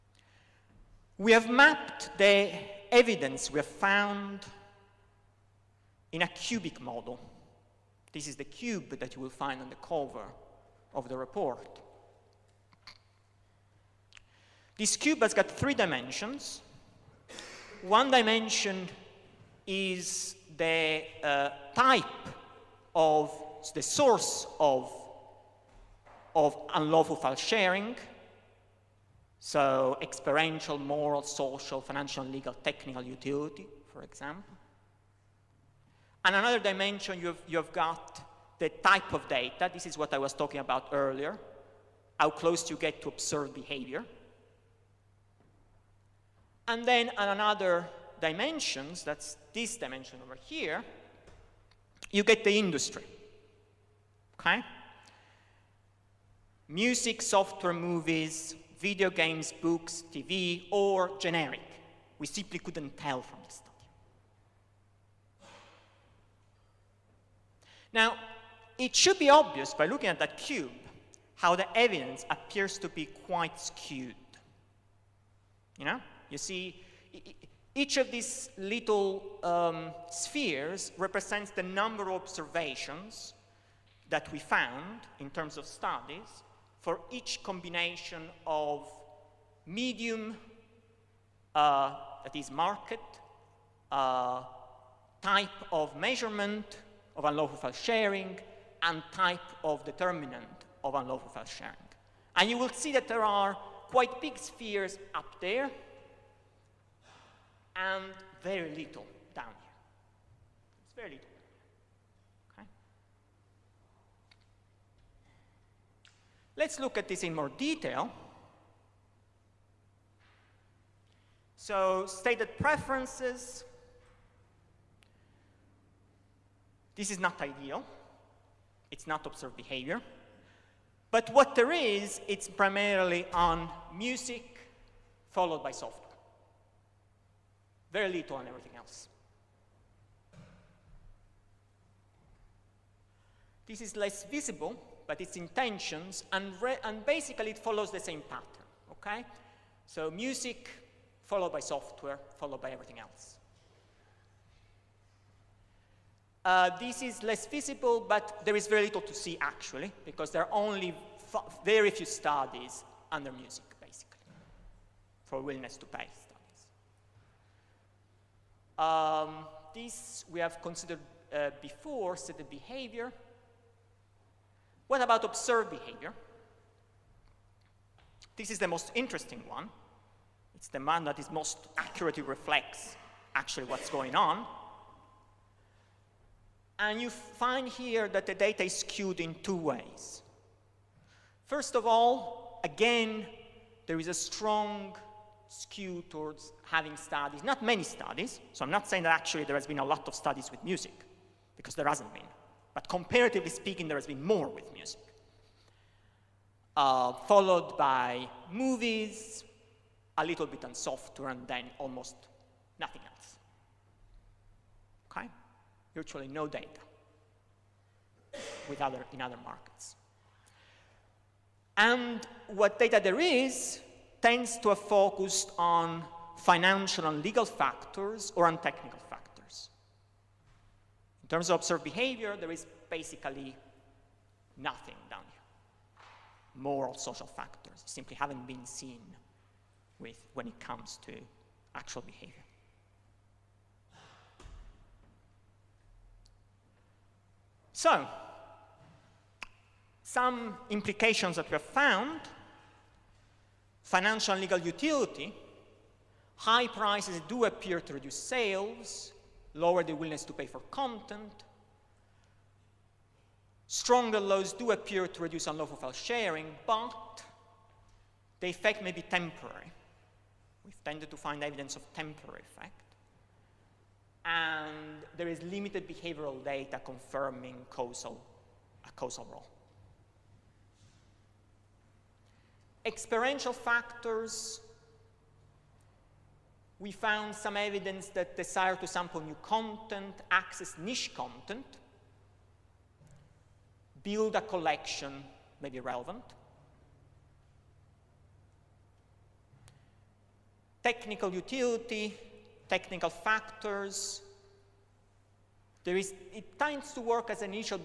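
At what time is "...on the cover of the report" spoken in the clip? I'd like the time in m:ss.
0:09.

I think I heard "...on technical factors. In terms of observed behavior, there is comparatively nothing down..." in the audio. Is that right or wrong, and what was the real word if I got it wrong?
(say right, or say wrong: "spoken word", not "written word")
wrong: "basically", not "comparatively".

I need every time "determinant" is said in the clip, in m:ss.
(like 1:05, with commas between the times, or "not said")
1:39.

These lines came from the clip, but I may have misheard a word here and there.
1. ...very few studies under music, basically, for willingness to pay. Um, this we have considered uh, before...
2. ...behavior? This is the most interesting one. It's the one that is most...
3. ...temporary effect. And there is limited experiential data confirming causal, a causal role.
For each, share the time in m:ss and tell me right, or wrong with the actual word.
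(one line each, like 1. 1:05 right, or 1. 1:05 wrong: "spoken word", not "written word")
1. 2:41 right
2. 2:55 right
3. 4:31 wrong: "behavioral", not "experiential".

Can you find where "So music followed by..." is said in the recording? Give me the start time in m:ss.
2:29.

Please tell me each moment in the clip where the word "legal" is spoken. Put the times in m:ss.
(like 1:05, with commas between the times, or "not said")
0:32, 3:47, 4:14.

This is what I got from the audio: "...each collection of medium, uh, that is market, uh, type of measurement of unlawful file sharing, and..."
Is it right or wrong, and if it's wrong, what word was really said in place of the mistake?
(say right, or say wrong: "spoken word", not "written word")
wrong: "combination", not "collection".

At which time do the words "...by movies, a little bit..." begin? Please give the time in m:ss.
3:27.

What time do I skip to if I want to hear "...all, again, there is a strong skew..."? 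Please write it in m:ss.
3:11.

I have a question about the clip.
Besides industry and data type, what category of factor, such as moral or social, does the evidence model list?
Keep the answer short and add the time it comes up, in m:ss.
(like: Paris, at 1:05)
Type of the source, at 0:21.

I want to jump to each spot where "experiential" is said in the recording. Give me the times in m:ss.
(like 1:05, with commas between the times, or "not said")
0:30, 4:42.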